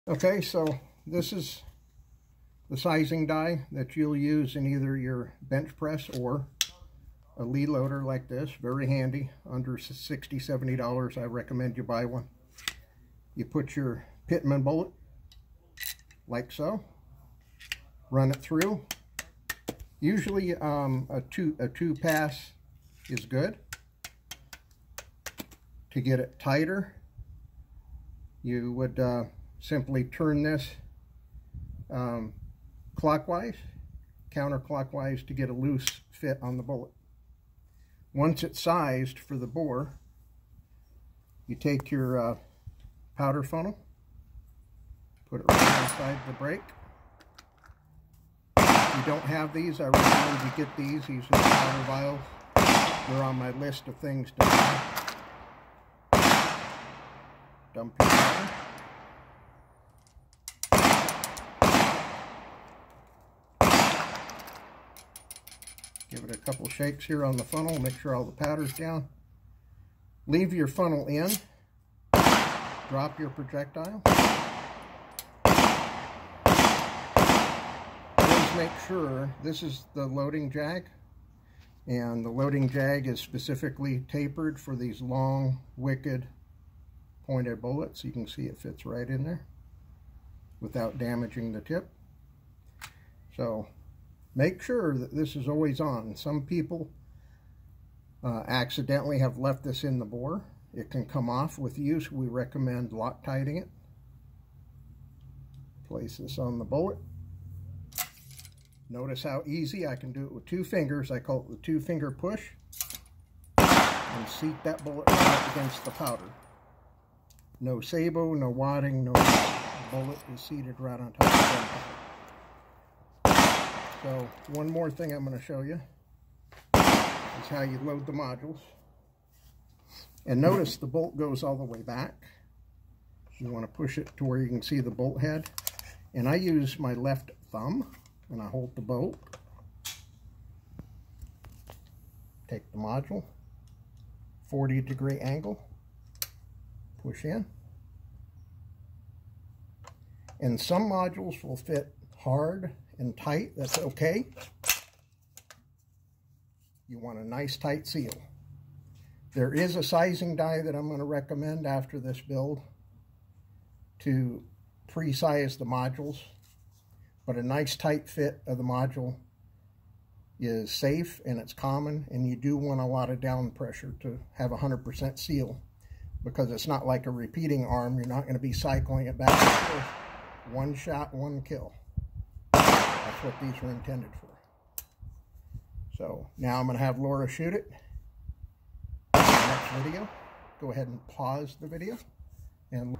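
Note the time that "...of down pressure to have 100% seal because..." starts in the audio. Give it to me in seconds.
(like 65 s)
173 s.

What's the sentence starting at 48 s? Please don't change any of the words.
If you don't have these, I recommend you get these.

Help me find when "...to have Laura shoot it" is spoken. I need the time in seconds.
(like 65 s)
186 s.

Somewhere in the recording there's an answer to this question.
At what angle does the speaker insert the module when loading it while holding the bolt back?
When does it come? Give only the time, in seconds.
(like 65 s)
144 s.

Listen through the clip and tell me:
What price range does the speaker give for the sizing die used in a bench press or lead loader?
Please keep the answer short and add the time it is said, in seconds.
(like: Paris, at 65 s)
Under $60-$70, at 9 s.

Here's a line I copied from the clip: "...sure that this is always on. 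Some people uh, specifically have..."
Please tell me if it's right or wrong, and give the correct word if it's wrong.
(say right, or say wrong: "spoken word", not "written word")
wrong: "accidentally", not "specifically".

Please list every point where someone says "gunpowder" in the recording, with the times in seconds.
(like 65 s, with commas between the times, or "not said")
121 s.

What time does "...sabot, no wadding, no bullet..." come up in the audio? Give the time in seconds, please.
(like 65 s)
117 s.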